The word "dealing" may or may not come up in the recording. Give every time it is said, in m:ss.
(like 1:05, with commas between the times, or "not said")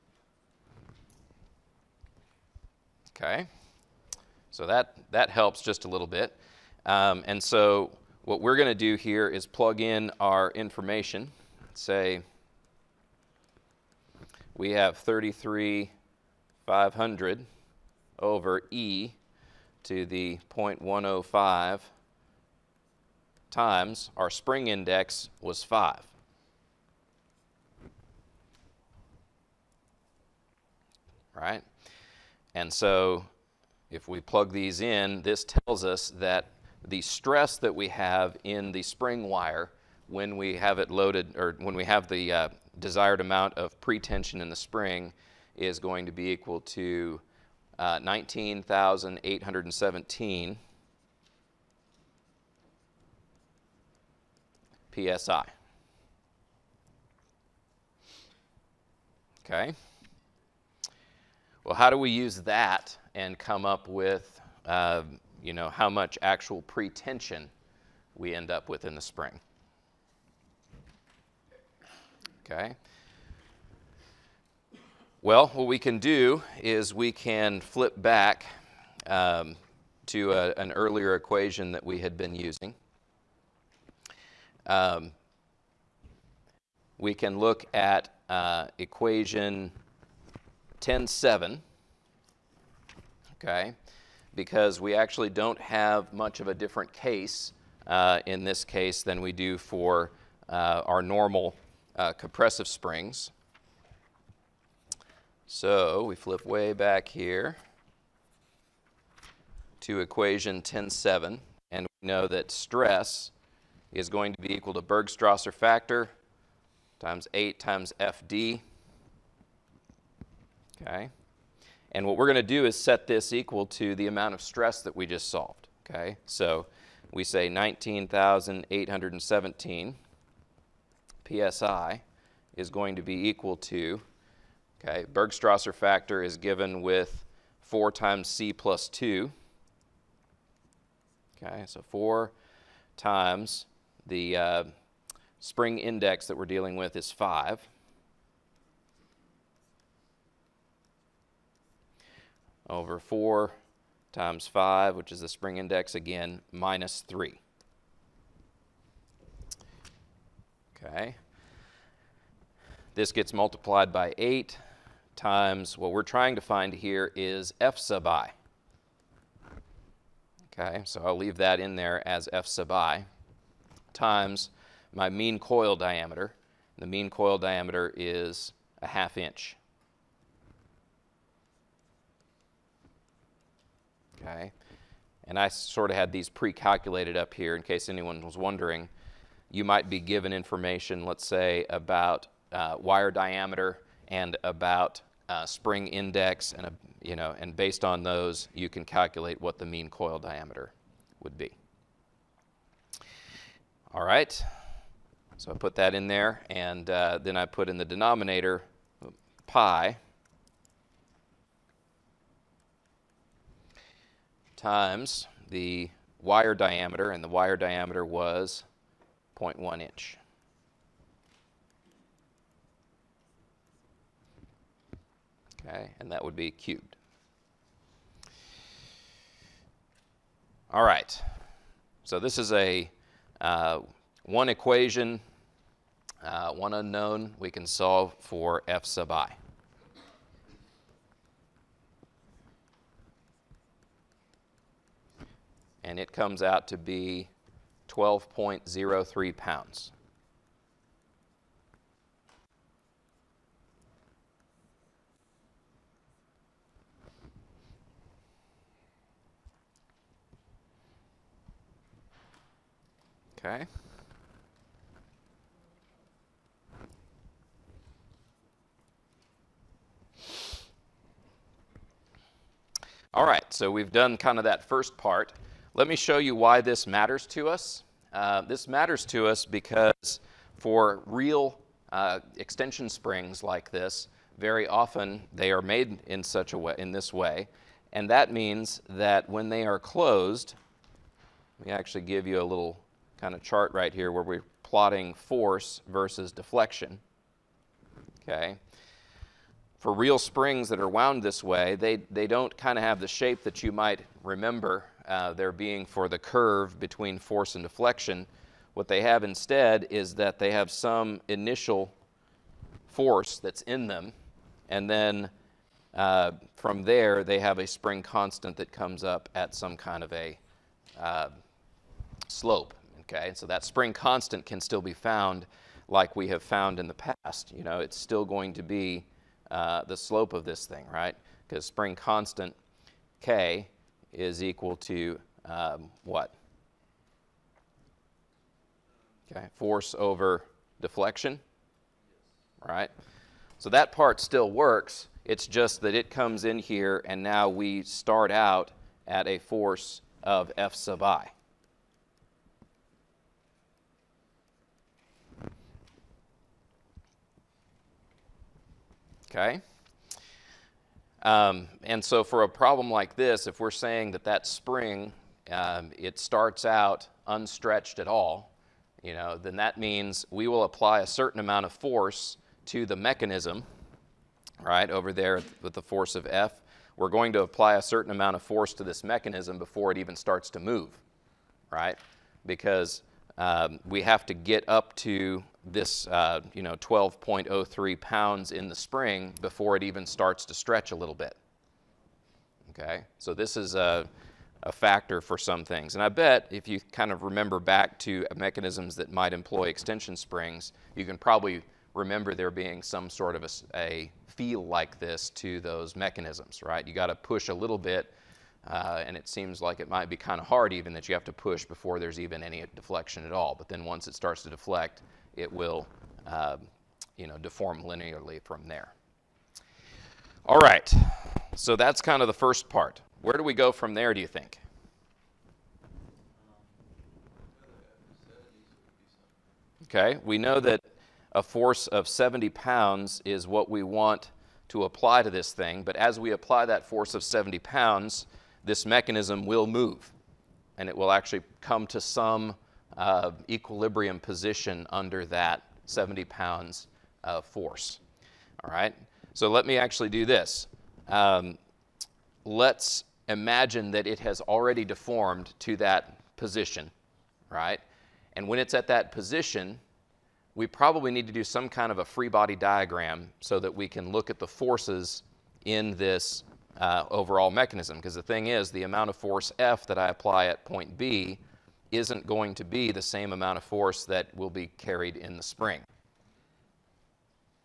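2:26.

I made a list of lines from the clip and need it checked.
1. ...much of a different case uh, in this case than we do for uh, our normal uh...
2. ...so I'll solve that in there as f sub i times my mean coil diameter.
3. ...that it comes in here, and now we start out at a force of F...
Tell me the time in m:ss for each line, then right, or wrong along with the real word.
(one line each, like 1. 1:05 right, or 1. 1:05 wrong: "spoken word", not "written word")
1. 1:36 right
2. 2:50 wrong: "leave", not "solve"
3. 5:45 right.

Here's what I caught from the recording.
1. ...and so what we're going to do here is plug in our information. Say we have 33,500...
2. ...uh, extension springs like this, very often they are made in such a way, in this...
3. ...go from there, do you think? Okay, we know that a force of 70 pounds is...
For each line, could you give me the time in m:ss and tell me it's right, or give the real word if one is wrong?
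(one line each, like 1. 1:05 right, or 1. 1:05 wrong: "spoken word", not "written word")
1. 0:07 right
2. 4:41 right
3. 7:03 right.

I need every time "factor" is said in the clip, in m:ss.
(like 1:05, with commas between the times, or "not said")
1:55, 2:15, 6:34.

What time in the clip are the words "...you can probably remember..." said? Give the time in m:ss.
6:40.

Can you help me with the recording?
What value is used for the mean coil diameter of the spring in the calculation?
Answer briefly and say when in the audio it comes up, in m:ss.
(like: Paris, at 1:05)
half inch, at 2:58.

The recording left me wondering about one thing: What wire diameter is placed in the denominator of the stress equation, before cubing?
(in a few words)
0.1 inch.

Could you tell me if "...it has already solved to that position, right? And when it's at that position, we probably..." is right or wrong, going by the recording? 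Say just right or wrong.
wrong.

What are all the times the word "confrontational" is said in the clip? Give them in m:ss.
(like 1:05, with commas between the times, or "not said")
not said.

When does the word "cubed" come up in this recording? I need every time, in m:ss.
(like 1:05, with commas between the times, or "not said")
3:46.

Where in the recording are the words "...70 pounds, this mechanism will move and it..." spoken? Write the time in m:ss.
7:17.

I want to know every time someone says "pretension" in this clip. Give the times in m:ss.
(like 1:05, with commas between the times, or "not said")
0:43, 1:06.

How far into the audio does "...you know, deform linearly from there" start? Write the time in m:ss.
6:57.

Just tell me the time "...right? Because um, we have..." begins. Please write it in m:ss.
6:21.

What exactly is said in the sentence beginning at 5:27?
You know, it's still going to be uh, the slope of this thing, right?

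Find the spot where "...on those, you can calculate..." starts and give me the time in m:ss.
3:17.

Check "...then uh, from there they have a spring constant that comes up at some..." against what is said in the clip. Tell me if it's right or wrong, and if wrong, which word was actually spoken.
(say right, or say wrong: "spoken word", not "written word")
right.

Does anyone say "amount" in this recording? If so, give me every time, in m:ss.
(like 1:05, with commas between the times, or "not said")
0:43, 2:04, 6:11, 6:18, 7:48, 7:53.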